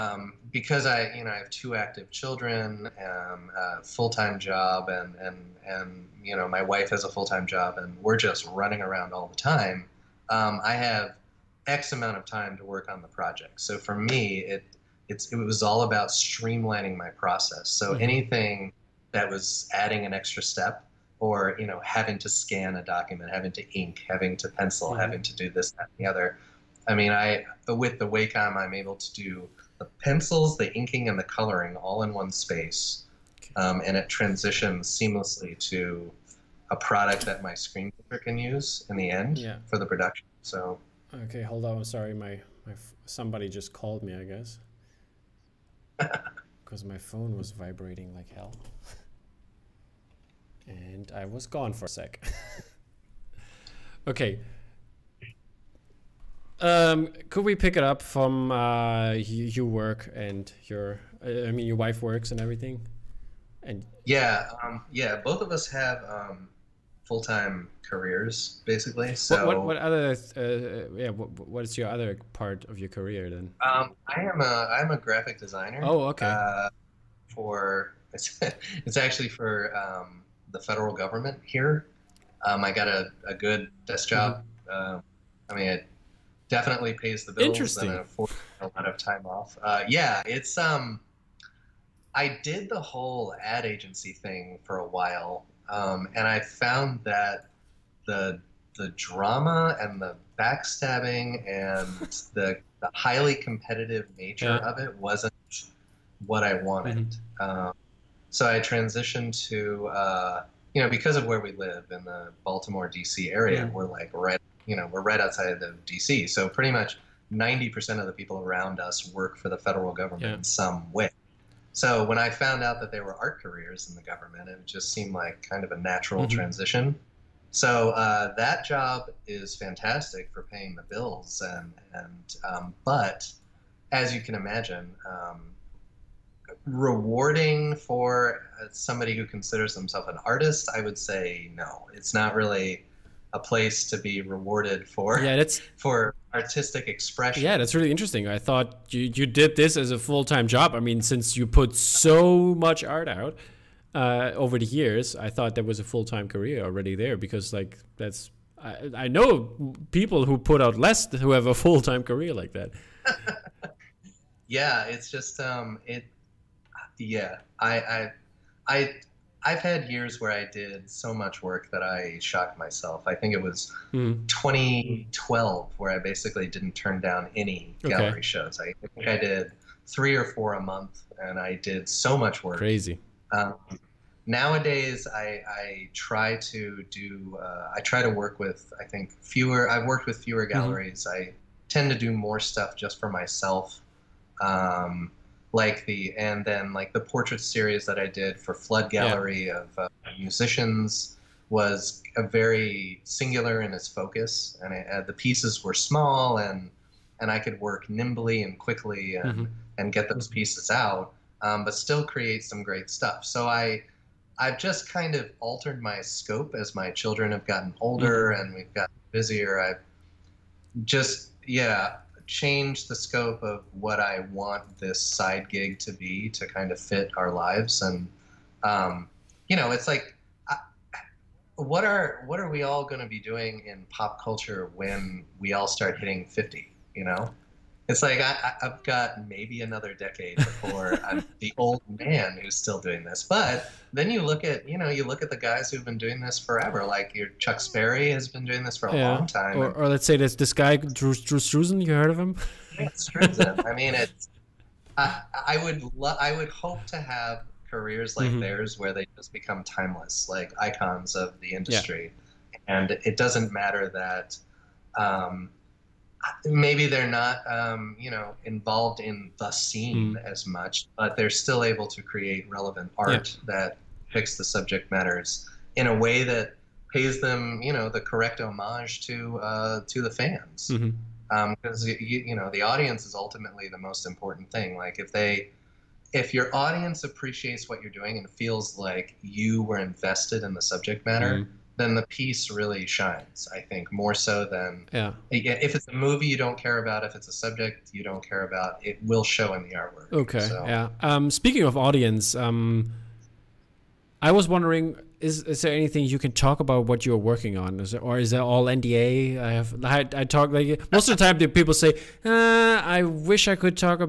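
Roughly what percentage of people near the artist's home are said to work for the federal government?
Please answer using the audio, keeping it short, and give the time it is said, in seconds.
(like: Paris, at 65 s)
90%, at 117 s.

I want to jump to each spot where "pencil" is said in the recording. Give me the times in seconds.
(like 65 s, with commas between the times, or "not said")
24 s, 30 s.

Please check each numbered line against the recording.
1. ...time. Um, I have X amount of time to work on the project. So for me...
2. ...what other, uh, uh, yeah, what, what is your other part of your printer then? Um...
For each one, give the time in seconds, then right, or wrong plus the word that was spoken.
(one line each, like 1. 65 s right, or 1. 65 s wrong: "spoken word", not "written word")
1. 9 s right
2. 69 s wrong: "career", not "printer".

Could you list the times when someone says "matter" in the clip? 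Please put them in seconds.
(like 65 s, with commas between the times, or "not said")
263 s, 274 s, 291 s.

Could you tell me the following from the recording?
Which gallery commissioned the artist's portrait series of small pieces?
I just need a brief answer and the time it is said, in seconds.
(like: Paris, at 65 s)
Flood Gallery, at 198 s.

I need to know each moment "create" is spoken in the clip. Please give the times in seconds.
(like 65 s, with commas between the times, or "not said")
212 s, 272 s.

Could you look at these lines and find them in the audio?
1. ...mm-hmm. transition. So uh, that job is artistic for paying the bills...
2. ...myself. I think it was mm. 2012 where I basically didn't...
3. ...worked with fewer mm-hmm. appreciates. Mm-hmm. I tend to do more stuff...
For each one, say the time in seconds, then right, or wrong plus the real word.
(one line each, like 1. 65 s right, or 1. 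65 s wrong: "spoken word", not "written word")
1. 126 s wrong: "fantastic", not "artistic"
2. 172 s right
3. 189 s wrong: "galleries", not "appreciates".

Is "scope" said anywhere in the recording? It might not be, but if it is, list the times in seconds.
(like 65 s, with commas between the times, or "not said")
216 s, 222 s.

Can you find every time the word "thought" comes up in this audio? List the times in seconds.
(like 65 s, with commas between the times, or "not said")
148 s, 155 s.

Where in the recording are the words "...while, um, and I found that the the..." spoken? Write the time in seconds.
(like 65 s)
94 s.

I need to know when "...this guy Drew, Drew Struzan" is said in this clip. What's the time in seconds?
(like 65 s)
250 s.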